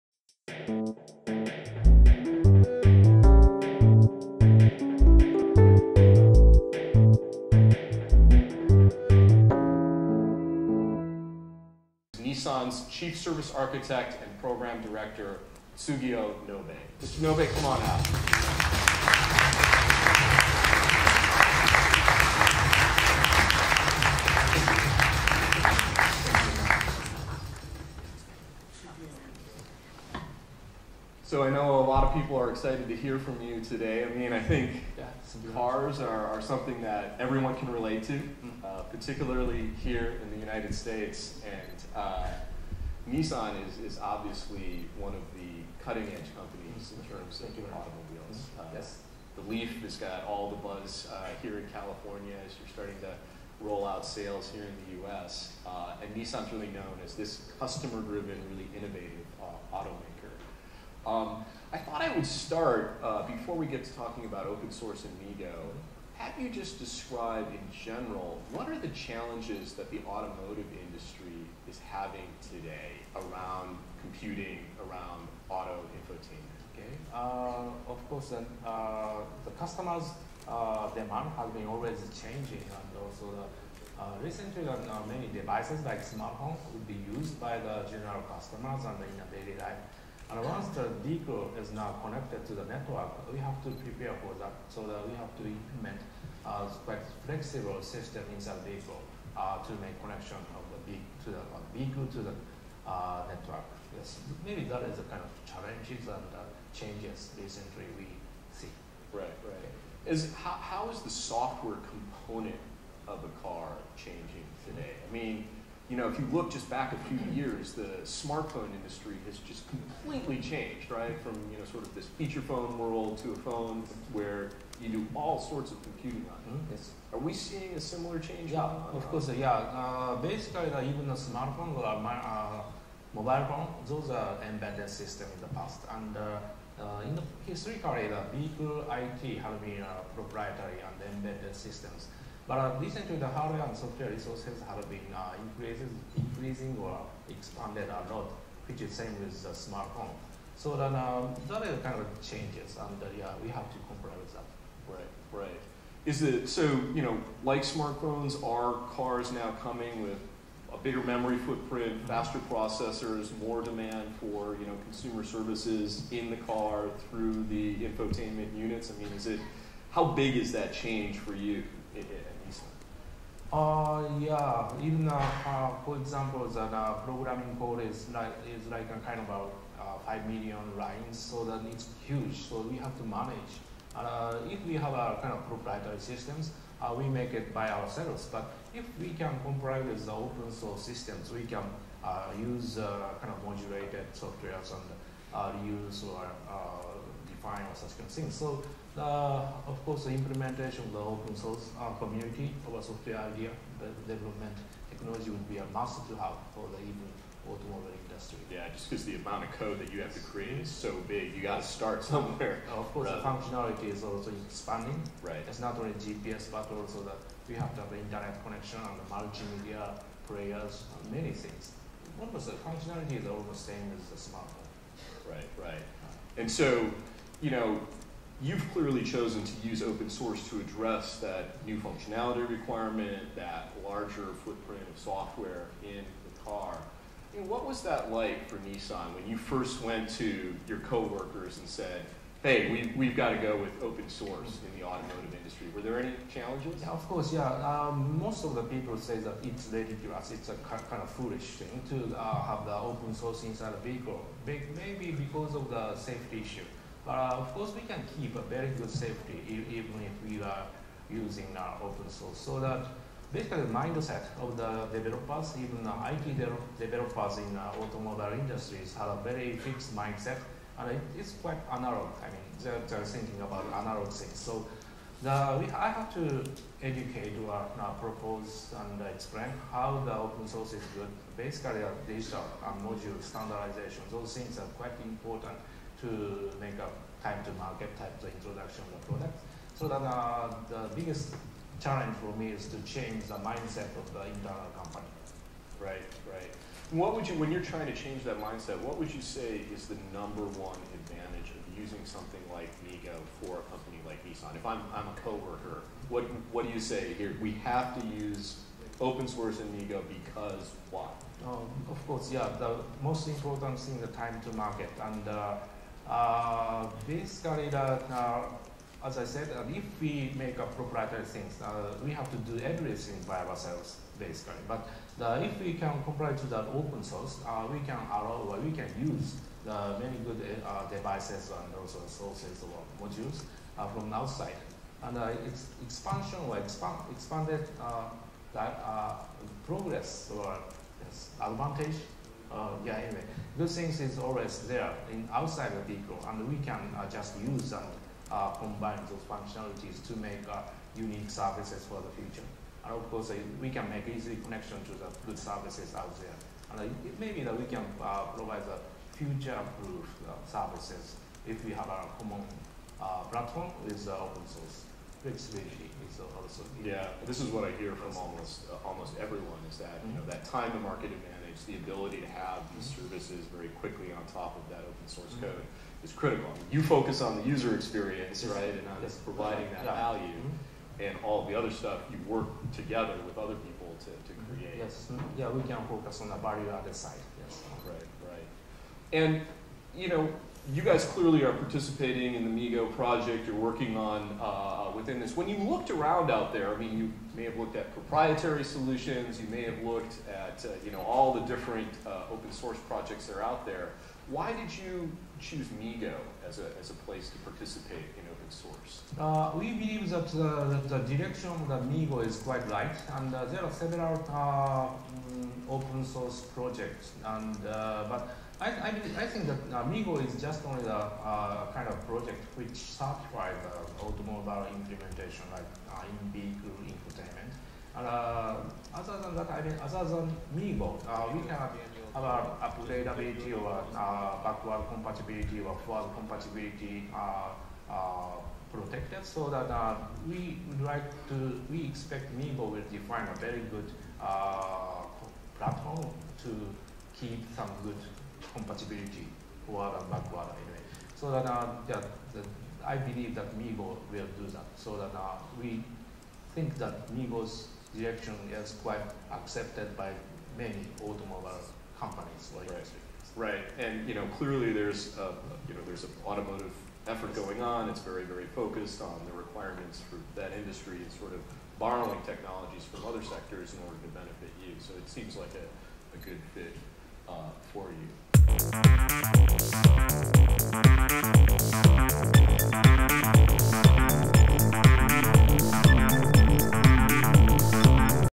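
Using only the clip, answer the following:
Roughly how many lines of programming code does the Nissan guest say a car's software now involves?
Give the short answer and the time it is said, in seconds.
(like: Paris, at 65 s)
5 million lines, at 180 s.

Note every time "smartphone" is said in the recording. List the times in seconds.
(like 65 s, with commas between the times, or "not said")
86 s, 118 s, 131 s, 149 s, 157 s, 224 s.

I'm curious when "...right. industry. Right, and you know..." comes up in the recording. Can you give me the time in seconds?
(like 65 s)
462 s.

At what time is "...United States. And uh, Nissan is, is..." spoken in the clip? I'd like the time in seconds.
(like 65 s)
40 s.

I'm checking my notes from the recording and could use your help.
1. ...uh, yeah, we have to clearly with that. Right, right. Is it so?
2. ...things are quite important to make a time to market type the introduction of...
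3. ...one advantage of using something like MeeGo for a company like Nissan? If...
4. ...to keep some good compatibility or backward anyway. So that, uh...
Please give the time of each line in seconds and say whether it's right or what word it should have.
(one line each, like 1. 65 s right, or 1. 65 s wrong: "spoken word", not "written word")
1. 153 s wrong: "comply", not "clearly"
2. 284 s right
3. 300 s right
4. 446 s right.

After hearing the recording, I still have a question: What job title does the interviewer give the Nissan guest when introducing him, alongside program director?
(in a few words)
Chief service architect.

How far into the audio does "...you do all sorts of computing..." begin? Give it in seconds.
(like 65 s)
124 s.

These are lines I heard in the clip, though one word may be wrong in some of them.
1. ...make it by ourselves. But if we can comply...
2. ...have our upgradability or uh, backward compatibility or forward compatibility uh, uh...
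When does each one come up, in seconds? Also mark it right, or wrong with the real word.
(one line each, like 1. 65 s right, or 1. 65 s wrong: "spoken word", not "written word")
1. 187 s right
2. 431 s right.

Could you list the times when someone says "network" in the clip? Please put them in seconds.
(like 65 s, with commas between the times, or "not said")
92 s, 103 s.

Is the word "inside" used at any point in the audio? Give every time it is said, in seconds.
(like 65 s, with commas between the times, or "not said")
98 s, 253 s.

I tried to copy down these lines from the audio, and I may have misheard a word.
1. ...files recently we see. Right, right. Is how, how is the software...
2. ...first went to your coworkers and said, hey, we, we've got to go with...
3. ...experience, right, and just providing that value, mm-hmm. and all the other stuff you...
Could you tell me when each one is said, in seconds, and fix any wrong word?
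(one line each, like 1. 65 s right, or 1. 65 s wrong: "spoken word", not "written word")
1. 106 s wrong: "changes", not "files"
2. 239 s right
3. 377 s right.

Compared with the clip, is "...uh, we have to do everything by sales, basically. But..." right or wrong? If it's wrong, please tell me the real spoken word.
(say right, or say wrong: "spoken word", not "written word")
wrong: "ourselves", not "sales".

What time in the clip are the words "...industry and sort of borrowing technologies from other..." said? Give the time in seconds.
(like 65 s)
470 s.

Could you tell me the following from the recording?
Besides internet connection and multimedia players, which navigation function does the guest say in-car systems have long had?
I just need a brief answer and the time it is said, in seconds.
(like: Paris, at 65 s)
GPS, at 215 s.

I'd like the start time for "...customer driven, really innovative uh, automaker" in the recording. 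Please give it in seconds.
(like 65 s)
57 s.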